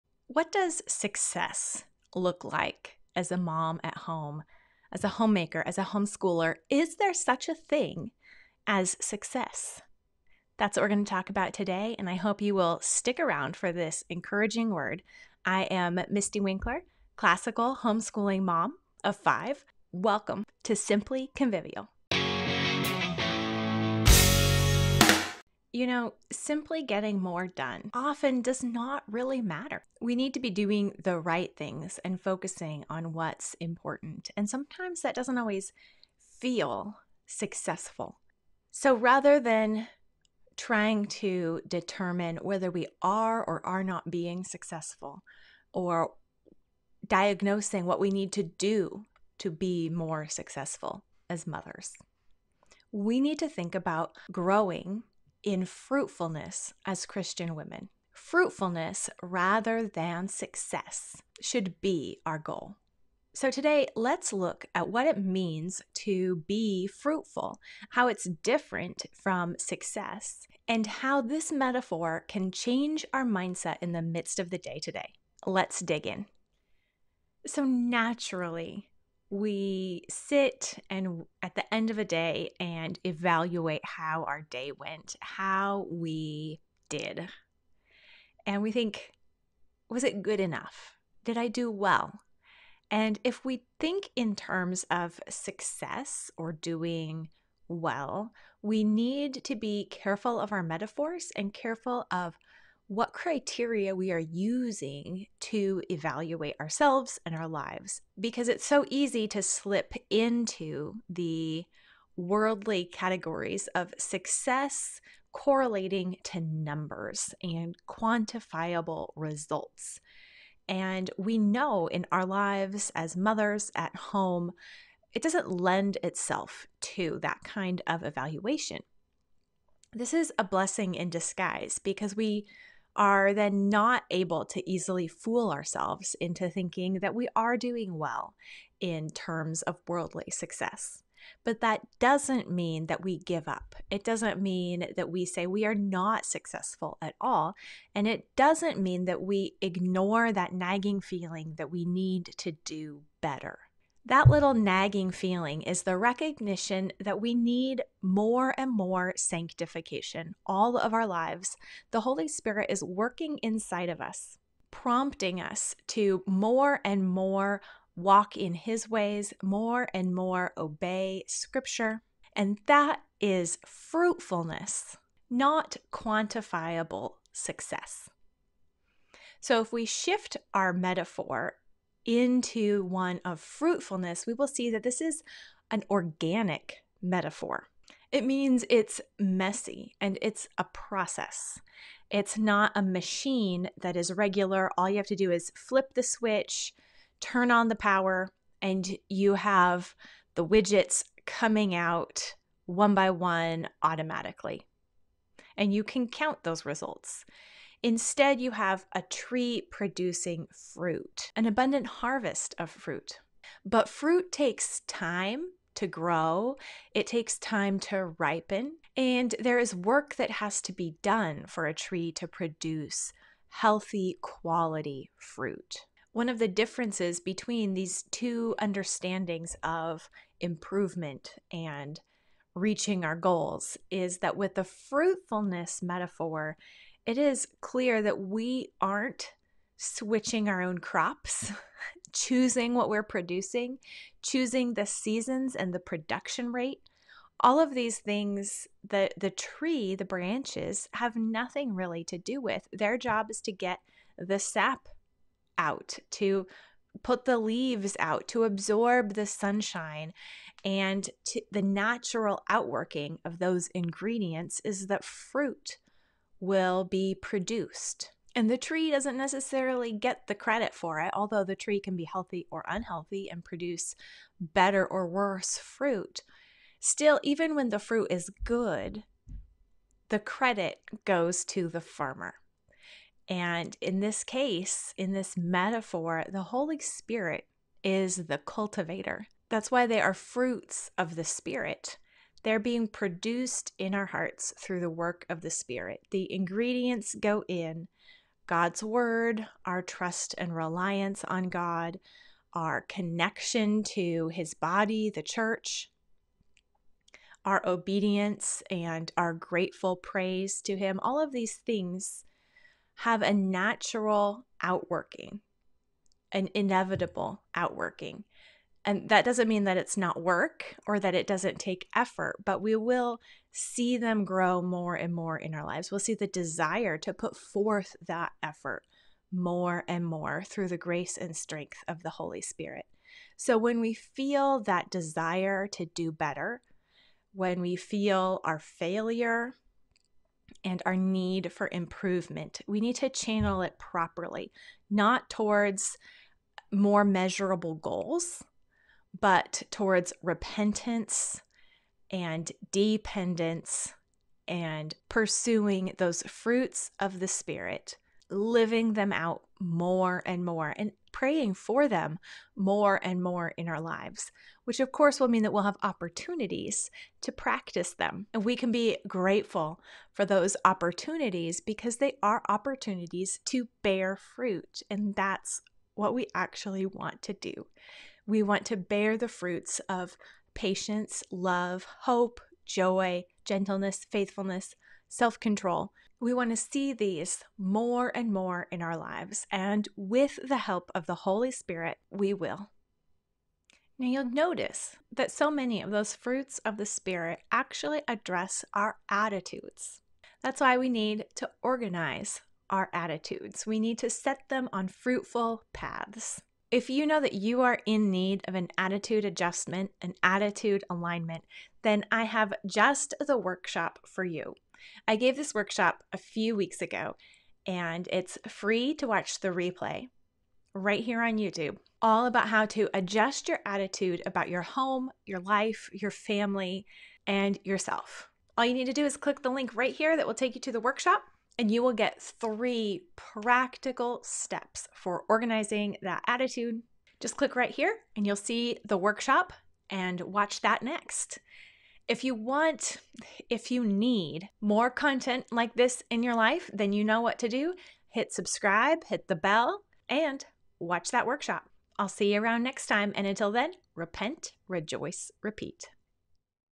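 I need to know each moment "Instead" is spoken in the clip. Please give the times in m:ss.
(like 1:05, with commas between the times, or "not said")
3:27.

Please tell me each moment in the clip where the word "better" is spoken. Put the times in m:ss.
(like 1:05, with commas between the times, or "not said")
2:33, 4:34, 5:36.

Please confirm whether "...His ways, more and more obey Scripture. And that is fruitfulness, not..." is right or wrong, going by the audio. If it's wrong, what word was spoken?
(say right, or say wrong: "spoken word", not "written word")
right.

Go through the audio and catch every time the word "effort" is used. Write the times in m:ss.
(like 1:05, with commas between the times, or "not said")
5:21, 5:28.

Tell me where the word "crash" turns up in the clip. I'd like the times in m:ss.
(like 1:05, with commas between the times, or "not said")
not said.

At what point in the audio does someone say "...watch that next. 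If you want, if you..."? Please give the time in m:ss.
7:20.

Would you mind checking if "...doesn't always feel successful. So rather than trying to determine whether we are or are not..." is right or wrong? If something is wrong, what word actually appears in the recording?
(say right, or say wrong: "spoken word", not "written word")
right.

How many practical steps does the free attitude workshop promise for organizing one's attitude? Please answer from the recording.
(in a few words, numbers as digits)
3.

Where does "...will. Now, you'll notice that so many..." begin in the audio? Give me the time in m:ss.
6:32.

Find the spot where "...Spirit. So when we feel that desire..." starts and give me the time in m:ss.
5:32.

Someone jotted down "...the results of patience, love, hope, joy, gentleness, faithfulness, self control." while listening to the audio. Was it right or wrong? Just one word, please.
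wrong.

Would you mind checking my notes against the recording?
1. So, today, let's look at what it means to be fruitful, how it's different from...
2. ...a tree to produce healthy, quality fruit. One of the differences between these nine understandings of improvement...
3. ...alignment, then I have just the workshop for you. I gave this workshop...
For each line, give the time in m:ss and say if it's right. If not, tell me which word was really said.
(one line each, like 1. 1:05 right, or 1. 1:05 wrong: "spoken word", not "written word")
1. 1:03 right
2. 3:41 wrong: "two", not "nine"
3. 6:50 right.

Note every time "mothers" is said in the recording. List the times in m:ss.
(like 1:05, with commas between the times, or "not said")
0:51, 2:03.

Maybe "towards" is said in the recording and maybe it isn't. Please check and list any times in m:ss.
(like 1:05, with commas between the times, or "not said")
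5:45, 5:49.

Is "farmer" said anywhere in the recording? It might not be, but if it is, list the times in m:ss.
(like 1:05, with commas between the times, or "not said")
4:41.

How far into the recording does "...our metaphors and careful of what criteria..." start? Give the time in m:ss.
1:40.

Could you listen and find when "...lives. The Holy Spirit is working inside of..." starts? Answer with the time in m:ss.
2:41.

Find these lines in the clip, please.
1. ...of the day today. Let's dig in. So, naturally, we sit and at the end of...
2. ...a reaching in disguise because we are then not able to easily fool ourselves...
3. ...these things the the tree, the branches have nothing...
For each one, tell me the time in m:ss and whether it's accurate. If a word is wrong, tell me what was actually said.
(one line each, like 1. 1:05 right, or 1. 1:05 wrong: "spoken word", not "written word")
1. 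1:14 right
2. 2:10 wrong: "blessing", not "reaching"
3. 4:07 right.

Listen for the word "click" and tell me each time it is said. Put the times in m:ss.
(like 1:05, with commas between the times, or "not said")
7:09, 7:17.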